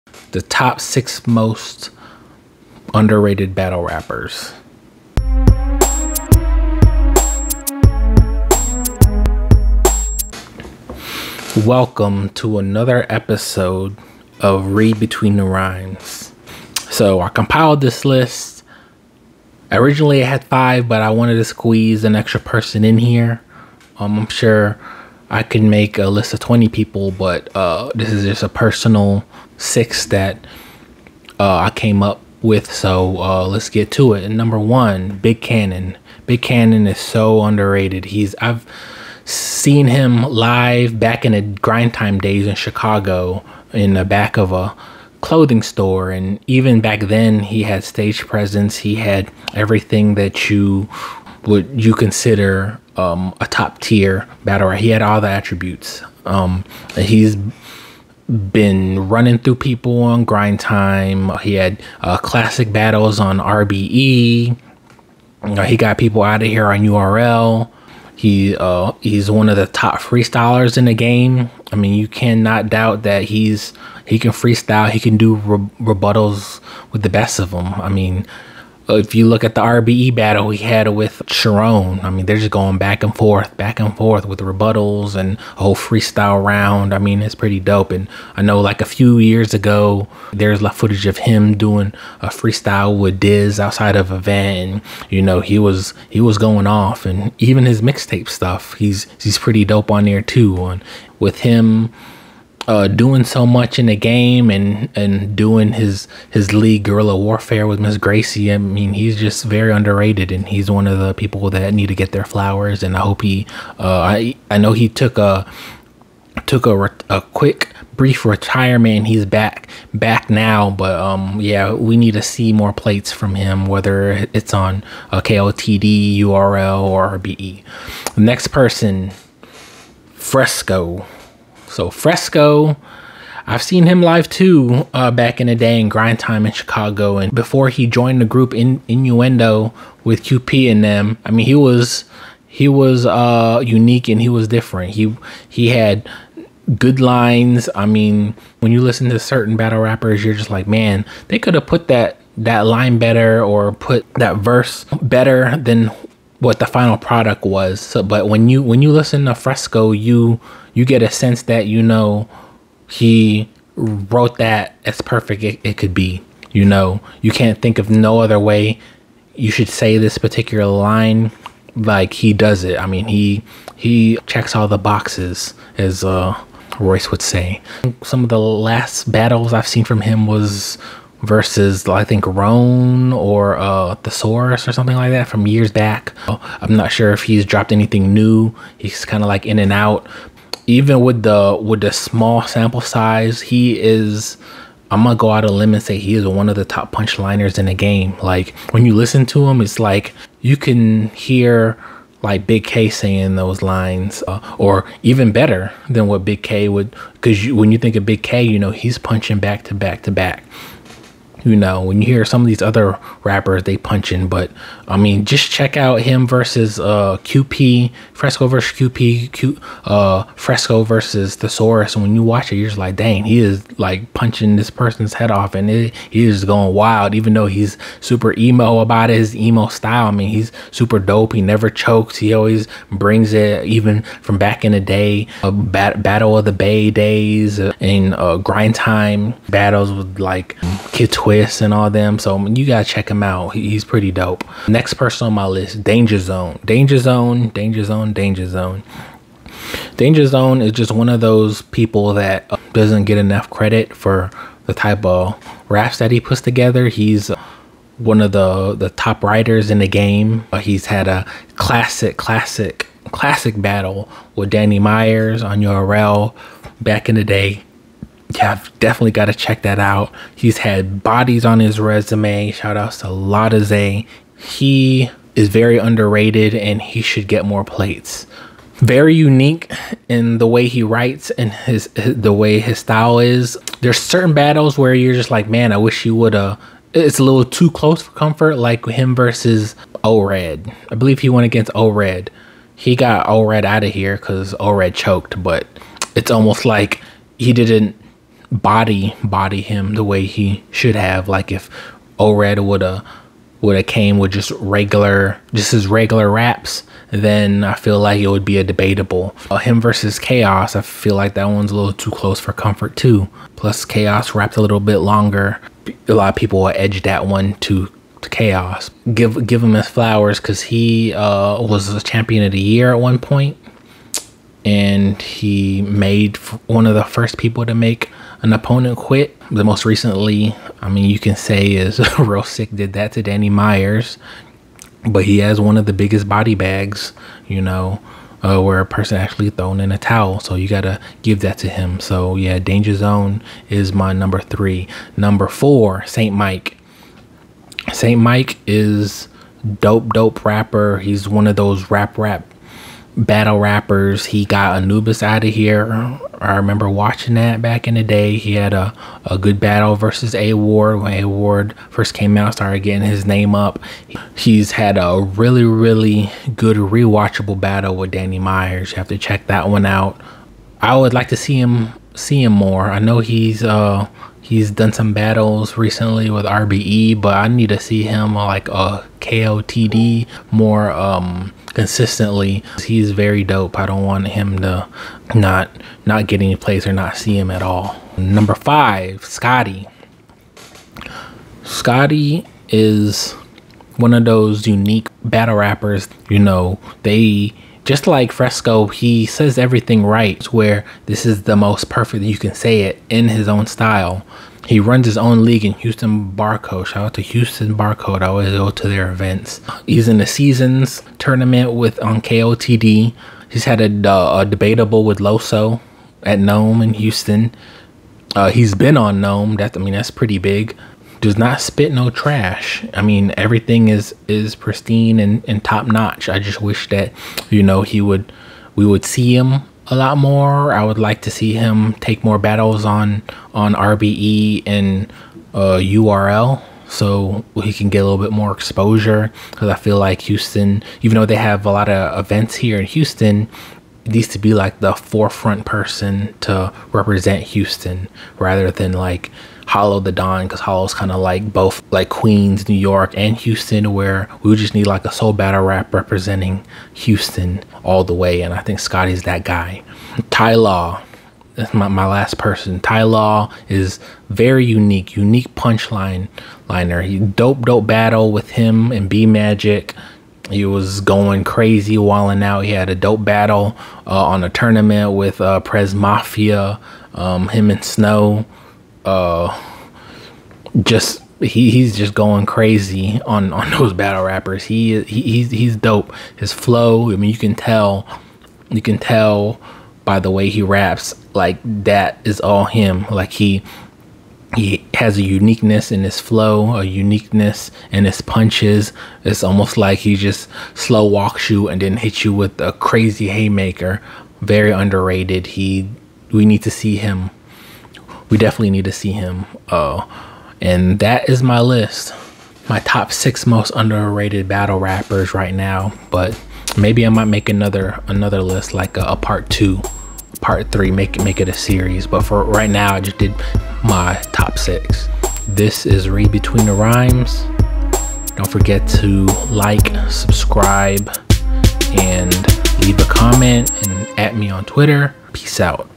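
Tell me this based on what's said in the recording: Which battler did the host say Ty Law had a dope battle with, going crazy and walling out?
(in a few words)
B Magic.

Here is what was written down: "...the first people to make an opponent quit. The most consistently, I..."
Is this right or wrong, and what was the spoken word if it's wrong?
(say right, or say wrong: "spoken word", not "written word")
wrong: "recently", not "consistently".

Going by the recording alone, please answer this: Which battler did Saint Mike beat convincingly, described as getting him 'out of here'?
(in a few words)
Anubis.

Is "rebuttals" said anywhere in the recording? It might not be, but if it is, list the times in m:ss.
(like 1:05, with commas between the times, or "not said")
1:15, 1:24.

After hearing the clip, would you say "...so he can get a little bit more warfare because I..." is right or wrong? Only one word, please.
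wrong.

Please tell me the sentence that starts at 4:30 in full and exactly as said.
He's had bodies on his resume.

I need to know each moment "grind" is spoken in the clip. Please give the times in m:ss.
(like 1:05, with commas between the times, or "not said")
0:41, 1:00, 2:15, 3:58.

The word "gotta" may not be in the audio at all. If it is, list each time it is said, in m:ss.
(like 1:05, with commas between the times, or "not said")
4:02, 5:40.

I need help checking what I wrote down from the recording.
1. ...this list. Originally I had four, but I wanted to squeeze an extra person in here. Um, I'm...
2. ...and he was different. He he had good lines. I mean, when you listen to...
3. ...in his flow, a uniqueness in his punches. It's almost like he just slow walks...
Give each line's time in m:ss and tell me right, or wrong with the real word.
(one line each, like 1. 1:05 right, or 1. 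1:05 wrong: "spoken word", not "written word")
1. 0:17 wrong: "five", not "four"
2. 2:24 right
3. 8:15 right.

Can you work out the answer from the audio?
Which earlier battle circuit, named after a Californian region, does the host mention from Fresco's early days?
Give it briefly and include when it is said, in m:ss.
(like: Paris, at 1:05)
Battle of the Bay, at 3:56.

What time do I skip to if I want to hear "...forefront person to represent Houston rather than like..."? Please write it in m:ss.
7:24.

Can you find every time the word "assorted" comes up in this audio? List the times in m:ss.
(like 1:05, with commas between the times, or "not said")
not said.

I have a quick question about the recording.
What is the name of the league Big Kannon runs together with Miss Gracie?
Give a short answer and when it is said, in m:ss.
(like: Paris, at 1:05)
Guerrilla Warfare, at 1:46.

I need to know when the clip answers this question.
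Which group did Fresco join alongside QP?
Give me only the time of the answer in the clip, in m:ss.
2:18.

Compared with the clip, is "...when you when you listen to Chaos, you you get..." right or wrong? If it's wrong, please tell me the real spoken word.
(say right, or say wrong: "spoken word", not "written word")
wrong: "Fresco", not "Chaos".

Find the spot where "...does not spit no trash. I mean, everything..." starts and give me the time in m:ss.
7:01.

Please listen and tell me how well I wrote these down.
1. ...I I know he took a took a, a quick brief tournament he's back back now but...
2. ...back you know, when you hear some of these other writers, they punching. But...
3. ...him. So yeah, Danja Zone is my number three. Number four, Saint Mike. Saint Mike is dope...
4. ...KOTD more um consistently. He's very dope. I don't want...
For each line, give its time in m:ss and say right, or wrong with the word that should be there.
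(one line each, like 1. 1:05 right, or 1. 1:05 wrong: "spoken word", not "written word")
1. 1:54 wrong: "retirement", not "tournament"
2. 3:30 wrong: "rappers", not "writers"
3. 5:41 right
4. 6:19 right.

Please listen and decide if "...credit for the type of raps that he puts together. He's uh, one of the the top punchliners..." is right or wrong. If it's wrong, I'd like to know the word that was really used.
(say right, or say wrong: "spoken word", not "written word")
wrong: "writers", not "punchliners".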